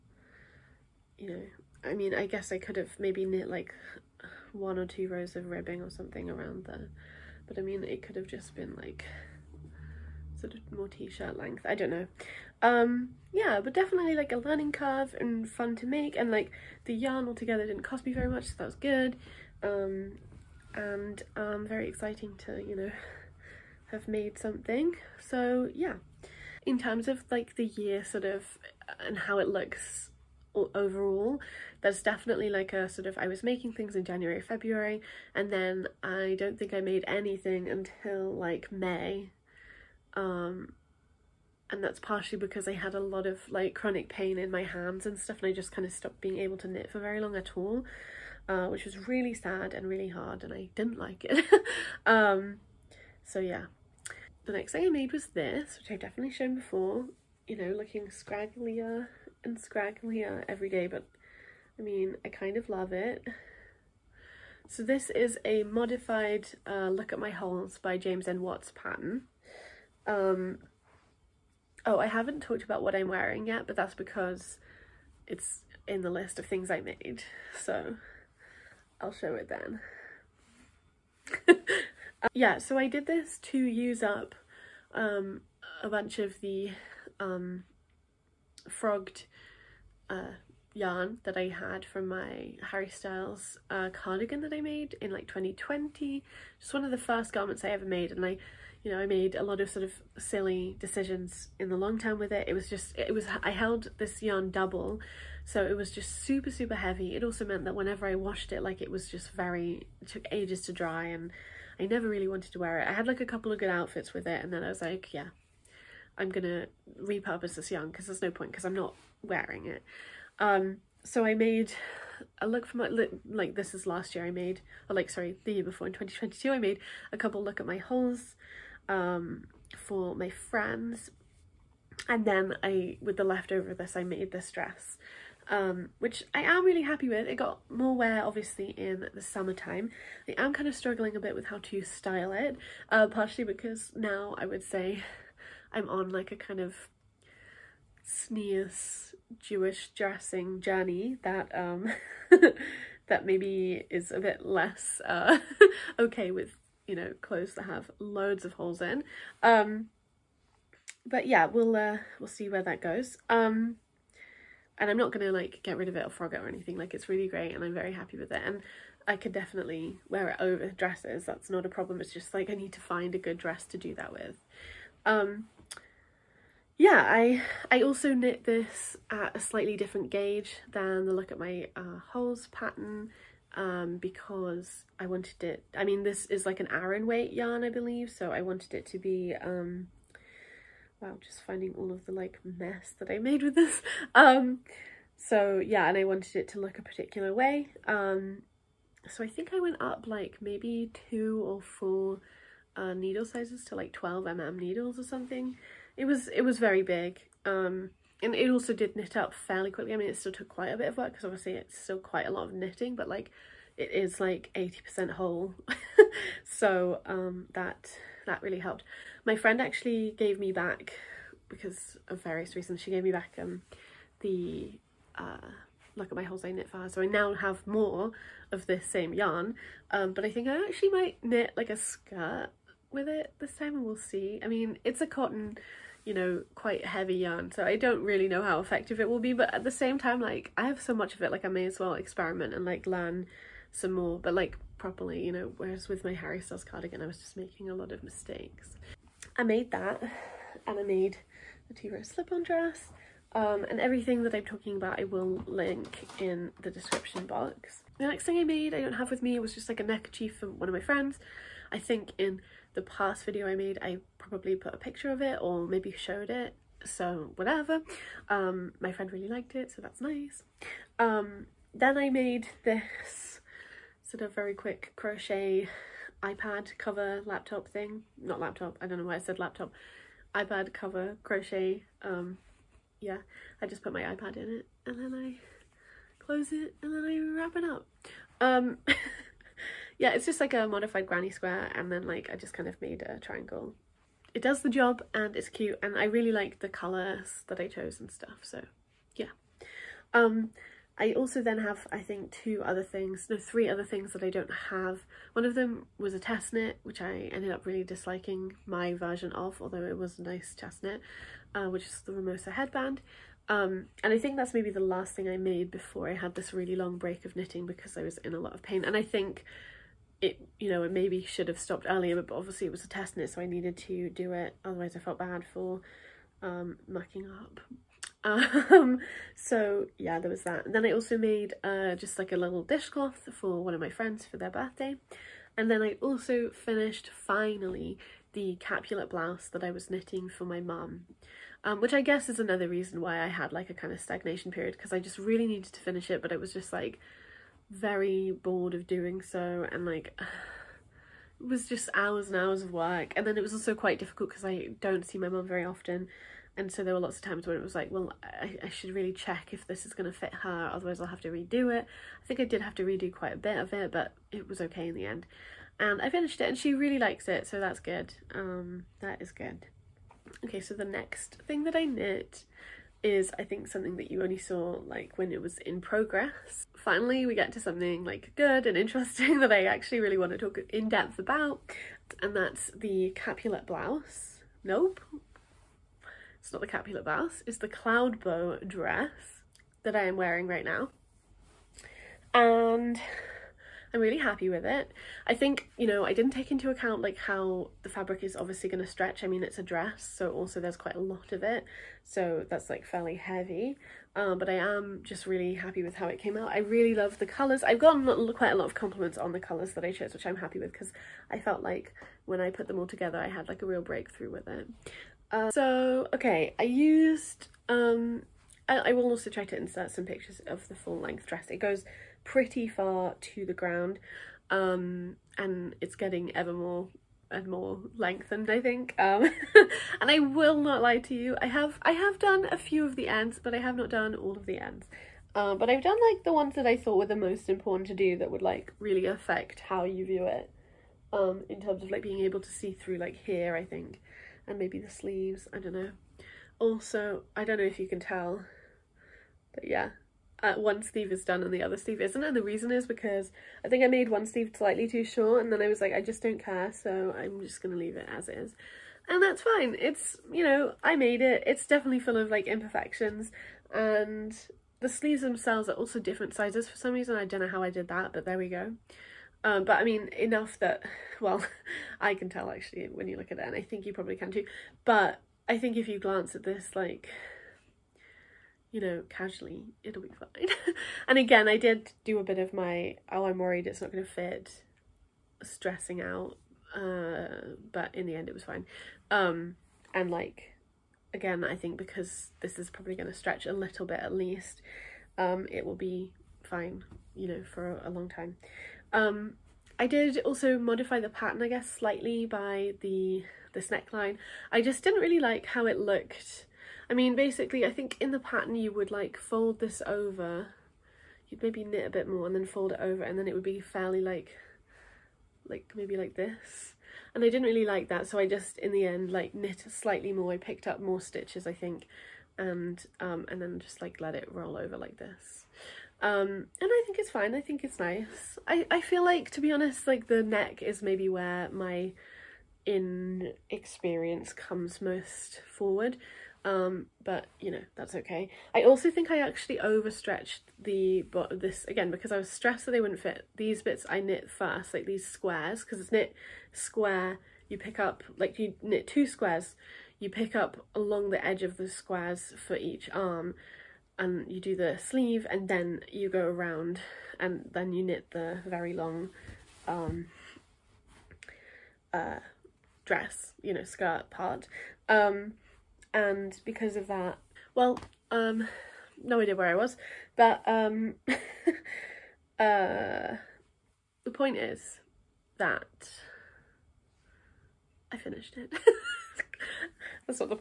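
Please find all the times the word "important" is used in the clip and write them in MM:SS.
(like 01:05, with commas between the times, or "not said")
07:17.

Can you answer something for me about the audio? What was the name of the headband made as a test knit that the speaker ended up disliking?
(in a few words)
Ramosa headband.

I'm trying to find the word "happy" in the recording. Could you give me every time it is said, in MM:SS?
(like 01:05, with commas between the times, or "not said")
02:16, 02:47, 06:34, 06:45, 06:50.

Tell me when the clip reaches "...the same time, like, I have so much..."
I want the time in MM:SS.
03:59.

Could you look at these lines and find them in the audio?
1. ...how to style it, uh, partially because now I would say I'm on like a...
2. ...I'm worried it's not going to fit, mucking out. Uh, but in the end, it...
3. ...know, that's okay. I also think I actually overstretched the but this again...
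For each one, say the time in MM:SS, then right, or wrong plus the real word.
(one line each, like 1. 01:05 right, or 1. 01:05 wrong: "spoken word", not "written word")
1. 02:21 right
2. 08:03 wrong: "stressing", not "mucking"
3. 08:57 right.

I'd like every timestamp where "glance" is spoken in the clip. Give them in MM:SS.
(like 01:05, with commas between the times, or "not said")
07:55.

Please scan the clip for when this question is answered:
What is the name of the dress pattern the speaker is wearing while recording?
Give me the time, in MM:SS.
06:27.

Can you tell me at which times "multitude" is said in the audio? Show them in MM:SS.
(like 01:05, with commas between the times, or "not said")
not said.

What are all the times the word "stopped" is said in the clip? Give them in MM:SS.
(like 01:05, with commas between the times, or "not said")
00:45, 05:21.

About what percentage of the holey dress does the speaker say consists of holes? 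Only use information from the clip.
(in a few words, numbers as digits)
80%.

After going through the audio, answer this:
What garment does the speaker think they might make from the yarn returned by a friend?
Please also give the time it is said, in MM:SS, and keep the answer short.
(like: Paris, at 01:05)
a skirt, at 03:51.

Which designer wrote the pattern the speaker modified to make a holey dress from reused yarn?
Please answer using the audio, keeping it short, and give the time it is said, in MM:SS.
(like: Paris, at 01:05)
James N. Watts, at 01:07.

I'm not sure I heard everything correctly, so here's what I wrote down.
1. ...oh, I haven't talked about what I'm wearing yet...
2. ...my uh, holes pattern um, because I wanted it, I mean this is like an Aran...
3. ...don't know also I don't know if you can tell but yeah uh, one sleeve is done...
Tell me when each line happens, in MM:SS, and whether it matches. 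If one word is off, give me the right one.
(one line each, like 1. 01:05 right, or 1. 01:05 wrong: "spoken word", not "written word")
1. 01:11 right
2. 03:01 right
3. 07:25 right.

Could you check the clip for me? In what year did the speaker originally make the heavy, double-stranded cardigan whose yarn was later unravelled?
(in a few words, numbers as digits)
2020.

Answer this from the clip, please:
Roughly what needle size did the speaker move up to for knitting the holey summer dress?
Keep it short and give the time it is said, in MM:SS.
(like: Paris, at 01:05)
12 mm, at 03:23.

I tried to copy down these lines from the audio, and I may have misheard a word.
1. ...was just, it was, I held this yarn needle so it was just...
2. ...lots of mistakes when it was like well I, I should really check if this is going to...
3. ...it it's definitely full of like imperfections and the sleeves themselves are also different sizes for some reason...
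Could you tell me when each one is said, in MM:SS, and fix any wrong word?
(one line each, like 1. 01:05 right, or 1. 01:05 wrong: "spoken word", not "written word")
1. 01:42 wrong: "double", not "needle"
2. 05:56 wrong: "times", not "mistakes"
3. 07:41 right.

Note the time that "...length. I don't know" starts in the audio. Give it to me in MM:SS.
00:11.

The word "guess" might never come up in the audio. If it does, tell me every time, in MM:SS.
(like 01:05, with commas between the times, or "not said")
00:02, 05:41, 08:21.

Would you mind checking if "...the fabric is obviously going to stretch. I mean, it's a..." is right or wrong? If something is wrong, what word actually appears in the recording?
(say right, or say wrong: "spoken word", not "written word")
right.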